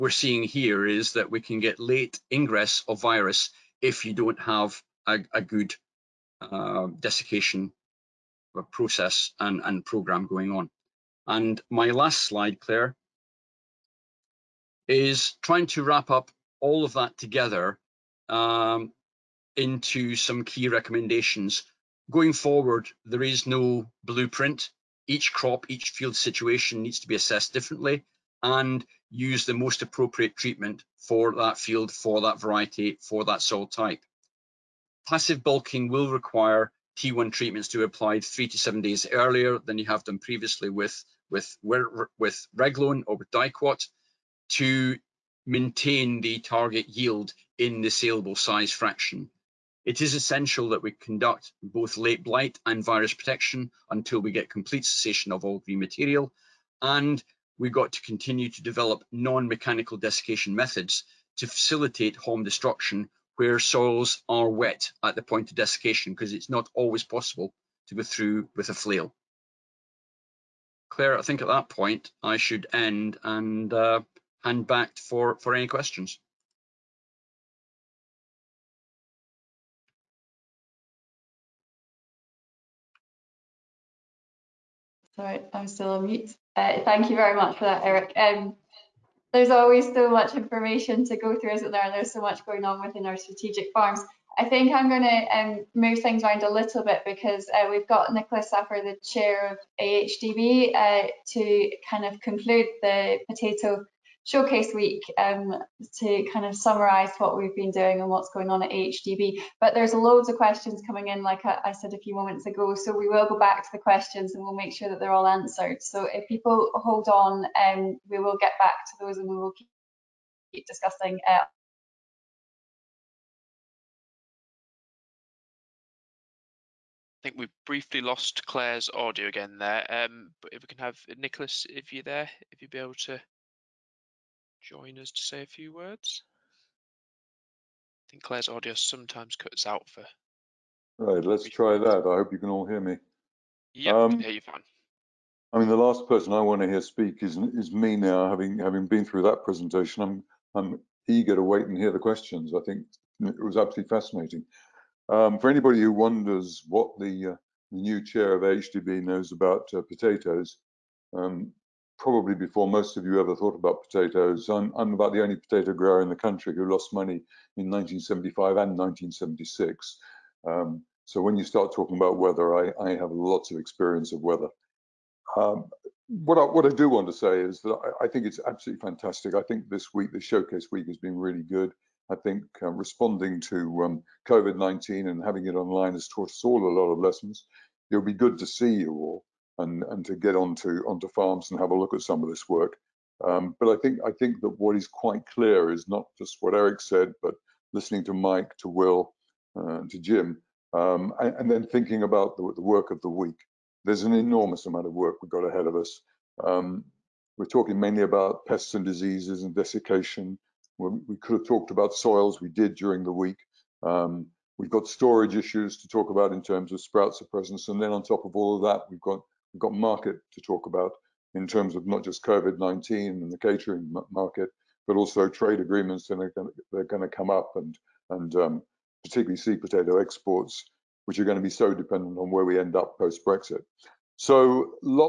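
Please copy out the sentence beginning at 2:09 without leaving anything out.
Um, but if we can have Nicholas, if you're there, if you'd be able to join us to say a few words?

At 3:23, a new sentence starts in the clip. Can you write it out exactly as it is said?
There's an enormous amount of work we've got ahead of us.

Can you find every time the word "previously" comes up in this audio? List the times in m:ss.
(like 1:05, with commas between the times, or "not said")
0:40.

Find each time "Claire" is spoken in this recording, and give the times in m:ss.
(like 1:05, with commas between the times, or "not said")
0:12, 1:10, 2:08, 2:18.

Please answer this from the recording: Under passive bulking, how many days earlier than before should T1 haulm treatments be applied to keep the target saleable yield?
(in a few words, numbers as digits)
3 to 7 days.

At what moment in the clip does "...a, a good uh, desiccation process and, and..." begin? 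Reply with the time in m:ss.
0:05.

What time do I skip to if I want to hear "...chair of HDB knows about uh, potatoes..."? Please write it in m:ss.
2:38.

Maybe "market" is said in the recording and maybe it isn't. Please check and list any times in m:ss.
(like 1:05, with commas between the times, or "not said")
3:39, 3:44.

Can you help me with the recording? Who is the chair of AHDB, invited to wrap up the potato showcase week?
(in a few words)
Nicholas Saphir.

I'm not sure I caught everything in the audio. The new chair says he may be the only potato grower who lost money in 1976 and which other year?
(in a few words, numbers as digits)
1975.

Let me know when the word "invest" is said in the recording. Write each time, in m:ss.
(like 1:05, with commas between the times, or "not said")
not said.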